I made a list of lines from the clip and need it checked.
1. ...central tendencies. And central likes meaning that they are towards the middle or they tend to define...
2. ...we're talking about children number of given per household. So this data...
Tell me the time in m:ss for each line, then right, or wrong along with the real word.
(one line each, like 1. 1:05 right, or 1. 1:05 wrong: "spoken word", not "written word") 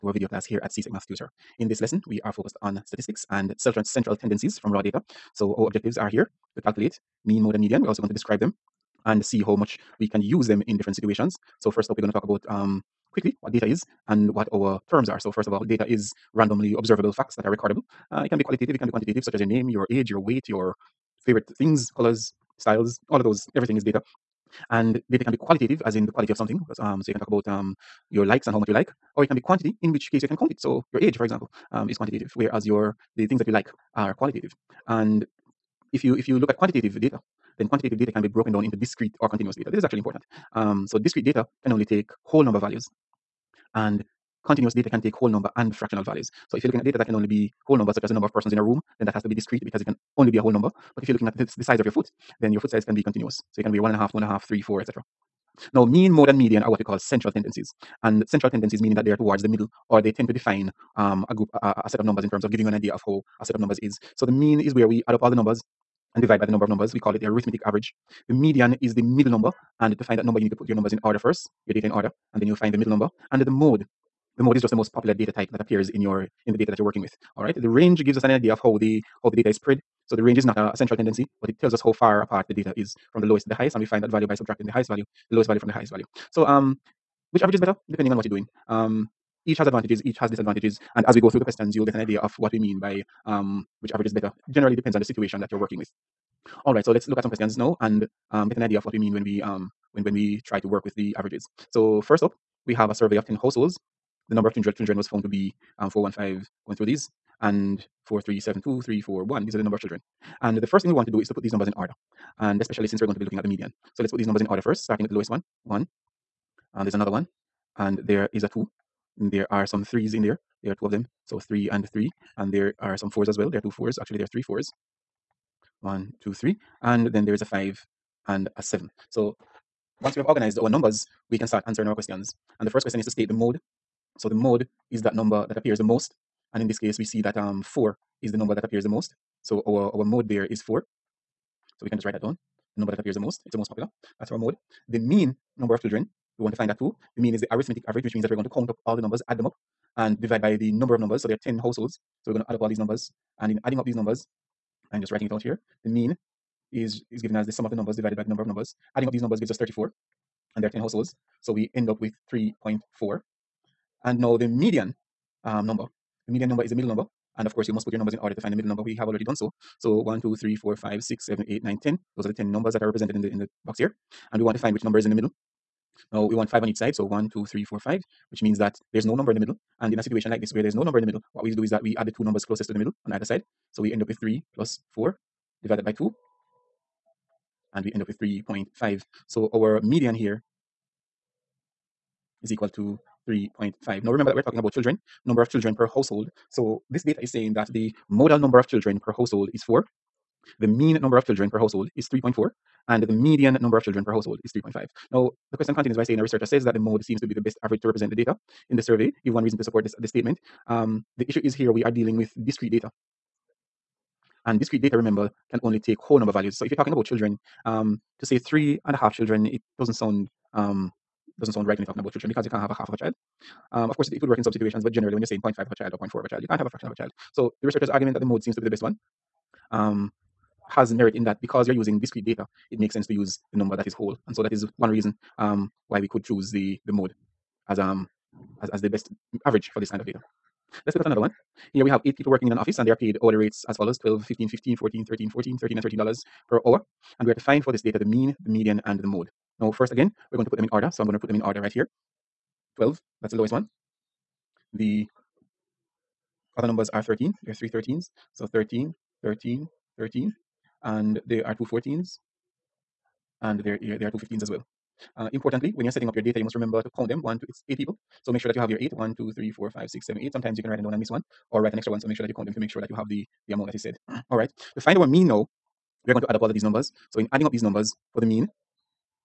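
1. 0:56 wrong: "tendencies", not "likes"
2. 3:14 wrong: "children", not "given".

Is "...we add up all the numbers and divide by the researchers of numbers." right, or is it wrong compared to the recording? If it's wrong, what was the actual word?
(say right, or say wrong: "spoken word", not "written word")
wrong: "number", not "researchers".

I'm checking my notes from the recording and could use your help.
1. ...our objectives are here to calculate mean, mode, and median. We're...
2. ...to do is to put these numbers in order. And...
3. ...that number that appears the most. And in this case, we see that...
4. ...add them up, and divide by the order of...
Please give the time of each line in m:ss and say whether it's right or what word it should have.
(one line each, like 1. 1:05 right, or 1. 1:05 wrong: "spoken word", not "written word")
1. 0:05 right
2. 1:51 right
3. 2:15 right
4. 2:29 wrong: "number", not "order".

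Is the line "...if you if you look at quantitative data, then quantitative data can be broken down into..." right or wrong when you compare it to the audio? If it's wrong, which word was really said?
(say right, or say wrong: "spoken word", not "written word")
right.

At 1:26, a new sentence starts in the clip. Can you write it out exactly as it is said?
So um, which average is better?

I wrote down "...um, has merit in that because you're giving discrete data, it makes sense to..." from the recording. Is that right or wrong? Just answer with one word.
wrong.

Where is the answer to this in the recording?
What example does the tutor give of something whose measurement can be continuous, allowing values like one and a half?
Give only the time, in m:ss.
0:52.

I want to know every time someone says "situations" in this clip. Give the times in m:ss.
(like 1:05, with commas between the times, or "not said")
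0:10, 1:35, 3:00, 3:44.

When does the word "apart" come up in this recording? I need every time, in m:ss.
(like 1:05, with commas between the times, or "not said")
1:22.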